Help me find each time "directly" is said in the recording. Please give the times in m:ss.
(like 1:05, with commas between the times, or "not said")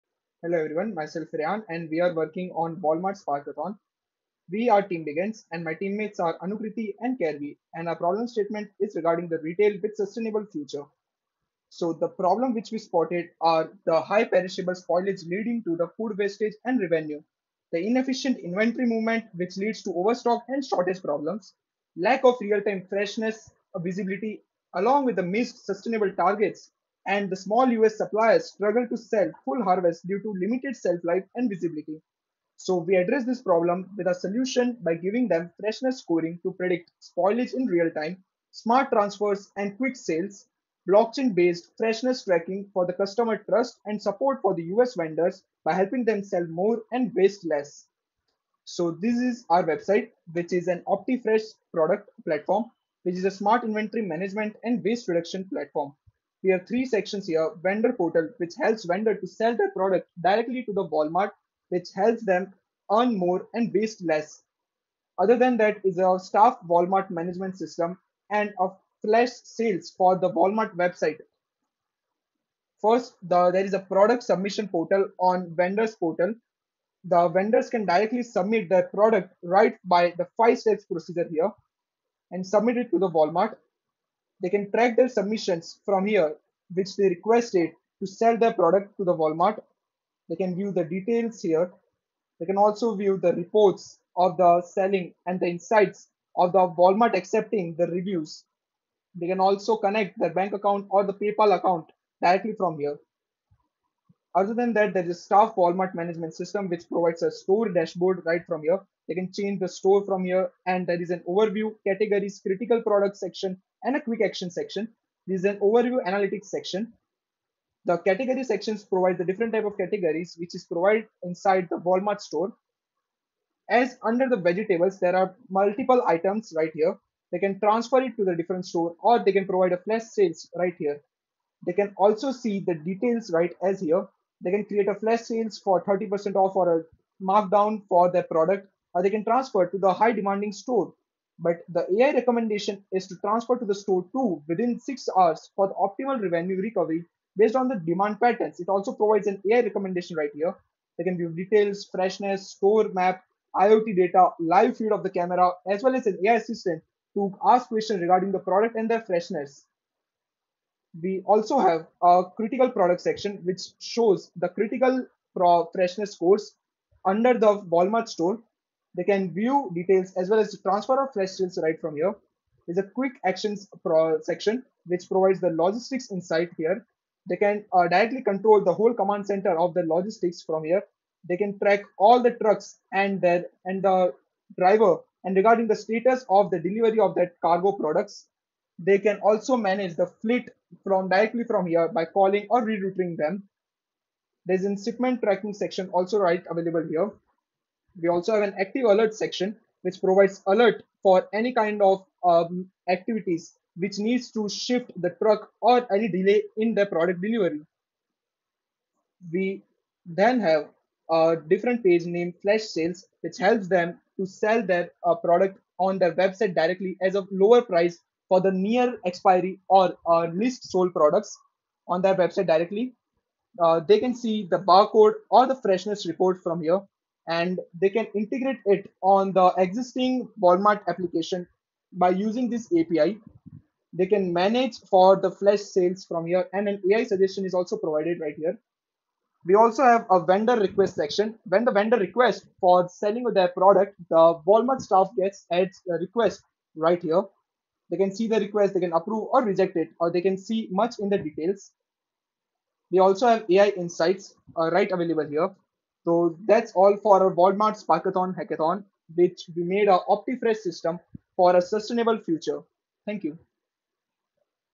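1:00, 1:17, 1:42, 2:57, 3:11, 3:36, 3:42.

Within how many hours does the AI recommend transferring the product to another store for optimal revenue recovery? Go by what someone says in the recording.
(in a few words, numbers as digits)
6.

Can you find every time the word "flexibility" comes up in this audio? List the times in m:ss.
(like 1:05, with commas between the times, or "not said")
not said.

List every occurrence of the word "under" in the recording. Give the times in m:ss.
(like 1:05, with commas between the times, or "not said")
2:04, 2:47.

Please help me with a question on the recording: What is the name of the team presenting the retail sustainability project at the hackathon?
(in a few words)
Team Begins.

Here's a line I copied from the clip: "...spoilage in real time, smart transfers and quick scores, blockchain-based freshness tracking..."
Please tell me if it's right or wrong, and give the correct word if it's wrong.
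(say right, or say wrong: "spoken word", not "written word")
wrong: "sales", not "scores".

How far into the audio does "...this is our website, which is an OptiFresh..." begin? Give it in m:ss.
0:48.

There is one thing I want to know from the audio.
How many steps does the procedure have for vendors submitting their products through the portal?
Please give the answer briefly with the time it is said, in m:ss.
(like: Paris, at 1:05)
5, at 1:20.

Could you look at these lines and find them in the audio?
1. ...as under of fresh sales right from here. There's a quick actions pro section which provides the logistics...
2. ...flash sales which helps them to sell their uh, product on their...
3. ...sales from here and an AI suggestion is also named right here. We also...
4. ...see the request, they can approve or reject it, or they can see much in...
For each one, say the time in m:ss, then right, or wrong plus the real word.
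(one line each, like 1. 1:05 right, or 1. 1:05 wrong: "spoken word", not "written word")
1. 2:50 wrong: "transfer", not "under"
2. 3:32 right
3. 3:55 wrong: "provided", not "named"
4. 4:08 right.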